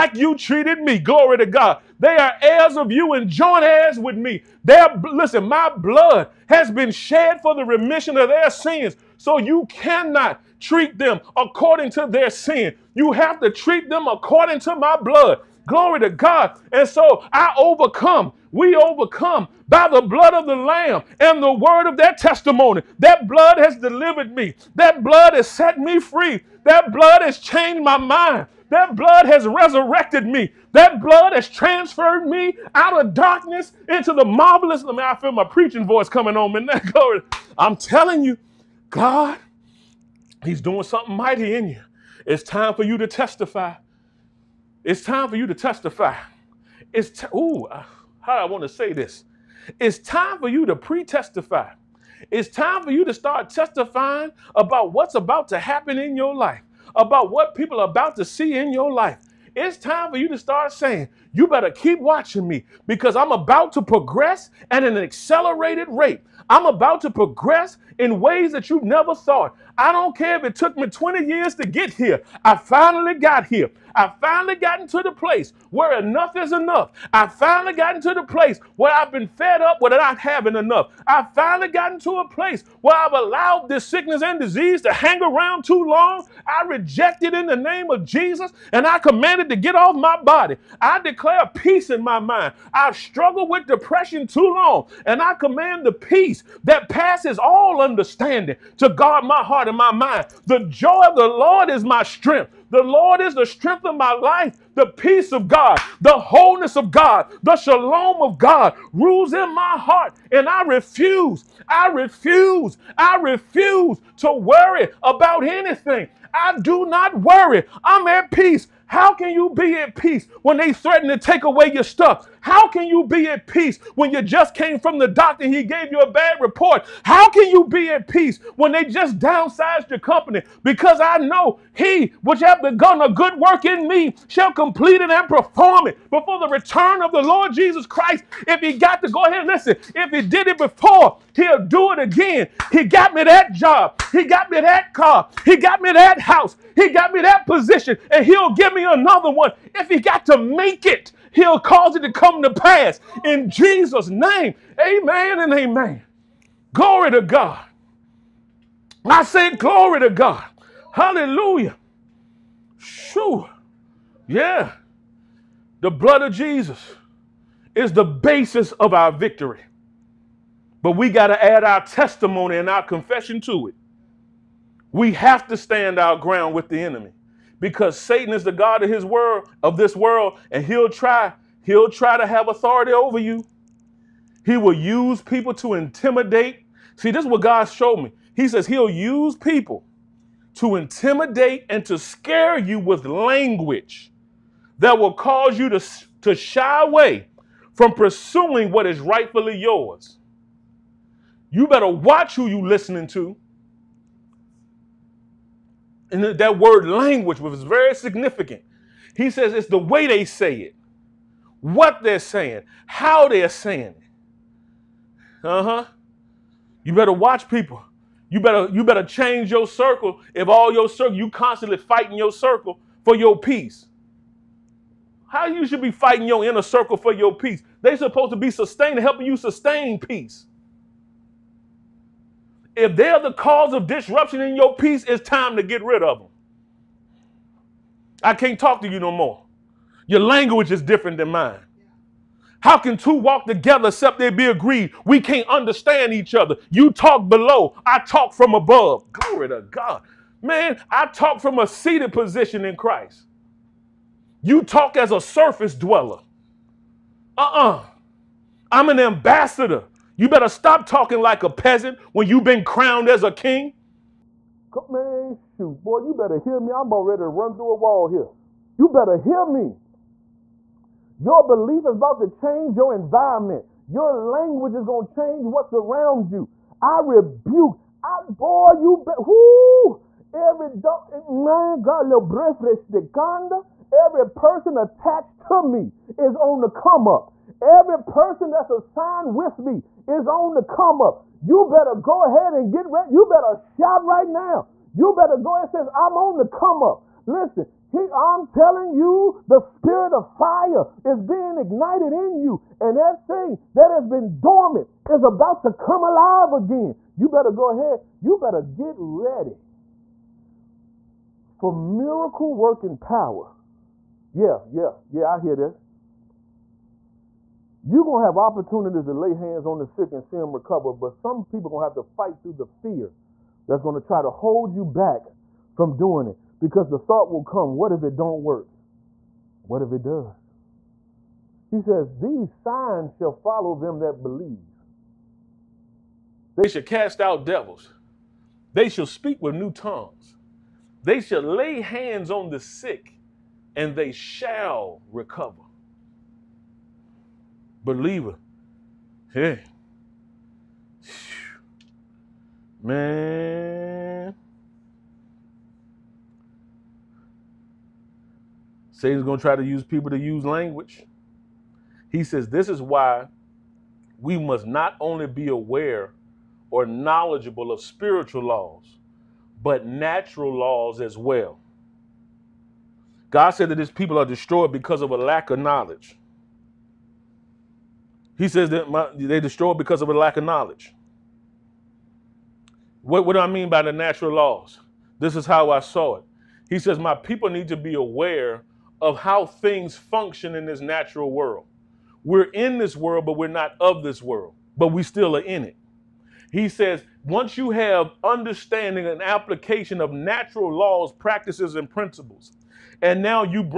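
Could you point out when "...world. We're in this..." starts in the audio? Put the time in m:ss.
6:31.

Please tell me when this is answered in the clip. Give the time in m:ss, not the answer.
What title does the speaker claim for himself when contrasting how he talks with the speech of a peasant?
4:18.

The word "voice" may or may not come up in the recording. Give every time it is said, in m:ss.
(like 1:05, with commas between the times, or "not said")
0:35.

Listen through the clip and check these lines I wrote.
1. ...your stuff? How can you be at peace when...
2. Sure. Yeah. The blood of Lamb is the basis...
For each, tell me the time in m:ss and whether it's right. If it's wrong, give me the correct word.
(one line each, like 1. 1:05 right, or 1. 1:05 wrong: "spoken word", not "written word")
1. 2:01 right
2. 2:42 wrong: "Jesus", not "Lamb".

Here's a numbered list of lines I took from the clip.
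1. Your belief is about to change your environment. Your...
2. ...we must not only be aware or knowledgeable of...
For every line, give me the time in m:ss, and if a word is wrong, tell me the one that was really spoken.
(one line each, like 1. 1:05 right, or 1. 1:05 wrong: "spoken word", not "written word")
1. 4:31 right
2. 6:04 right.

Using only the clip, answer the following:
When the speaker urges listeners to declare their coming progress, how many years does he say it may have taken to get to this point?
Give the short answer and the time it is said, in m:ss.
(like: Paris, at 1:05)
20, at 1:10.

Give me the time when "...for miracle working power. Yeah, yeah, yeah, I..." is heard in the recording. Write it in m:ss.
5:11.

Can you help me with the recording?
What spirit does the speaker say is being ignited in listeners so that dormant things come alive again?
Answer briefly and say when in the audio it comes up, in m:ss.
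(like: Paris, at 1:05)
spirit of fire, at 4:59.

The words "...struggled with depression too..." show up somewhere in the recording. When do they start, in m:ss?
1:32.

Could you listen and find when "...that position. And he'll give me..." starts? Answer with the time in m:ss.
2:27.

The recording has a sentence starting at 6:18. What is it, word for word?
He says that my, they destroy because of a lack of knowledge.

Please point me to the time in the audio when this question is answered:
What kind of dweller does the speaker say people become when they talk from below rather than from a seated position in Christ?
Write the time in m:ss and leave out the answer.
4:15.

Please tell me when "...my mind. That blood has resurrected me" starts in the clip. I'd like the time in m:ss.
0:27.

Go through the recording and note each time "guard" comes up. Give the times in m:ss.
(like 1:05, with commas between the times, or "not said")
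1:38.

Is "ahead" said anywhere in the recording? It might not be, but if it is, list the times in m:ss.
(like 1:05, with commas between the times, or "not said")
2:19, 4:52, 5:07.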